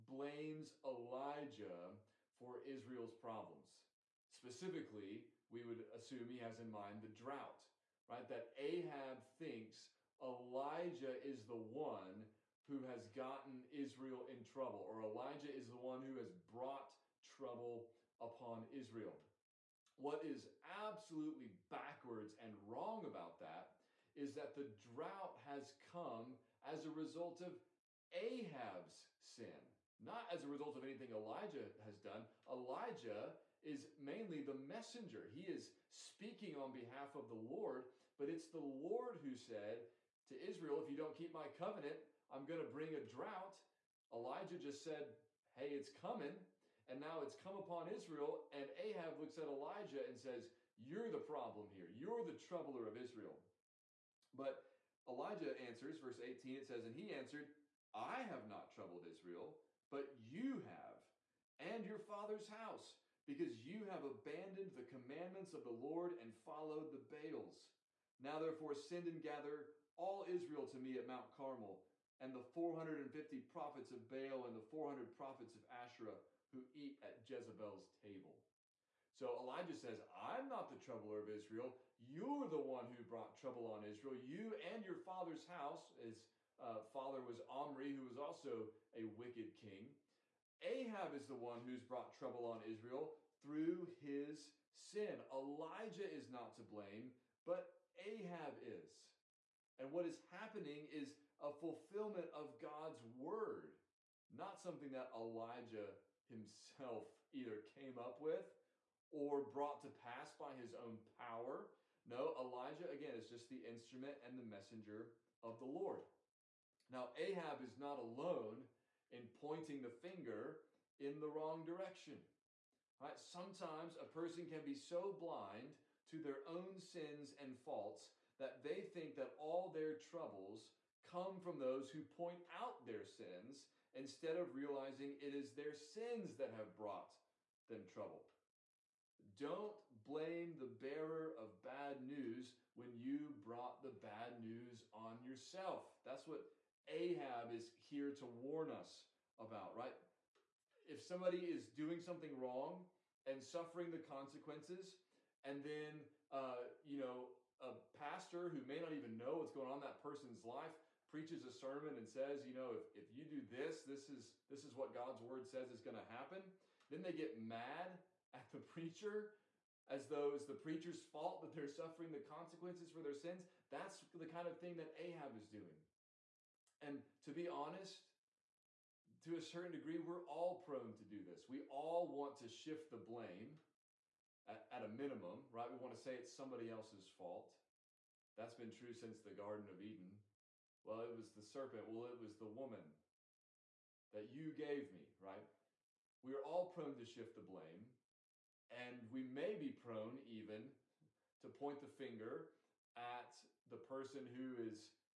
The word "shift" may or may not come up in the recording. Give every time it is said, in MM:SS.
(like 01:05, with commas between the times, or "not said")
03:02, 03:17.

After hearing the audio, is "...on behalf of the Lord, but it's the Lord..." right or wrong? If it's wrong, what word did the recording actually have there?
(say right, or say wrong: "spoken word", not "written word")
right.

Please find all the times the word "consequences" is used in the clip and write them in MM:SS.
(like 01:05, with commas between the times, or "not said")
02:34, 02:52.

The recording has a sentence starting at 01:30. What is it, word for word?
Ahab is the one who's brought trouble on Israel through his sin.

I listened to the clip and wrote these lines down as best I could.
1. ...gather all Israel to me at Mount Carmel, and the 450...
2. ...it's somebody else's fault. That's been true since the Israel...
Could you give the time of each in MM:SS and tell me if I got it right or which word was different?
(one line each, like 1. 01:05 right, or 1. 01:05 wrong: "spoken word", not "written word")
1. 01:09 right
2. 03:06 wrong: "Garden", not "Israel".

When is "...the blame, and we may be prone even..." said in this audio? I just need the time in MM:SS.
03:17.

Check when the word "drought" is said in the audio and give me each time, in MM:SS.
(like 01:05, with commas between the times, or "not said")
00:07, 00:24, 00:43.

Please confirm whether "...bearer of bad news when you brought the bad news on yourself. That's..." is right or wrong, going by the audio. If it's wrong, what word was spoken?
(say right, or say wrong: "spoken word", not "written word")
right.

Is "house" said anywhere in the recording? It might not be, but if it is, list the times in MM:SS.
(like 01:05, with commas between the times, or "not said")
01:02, 01:25.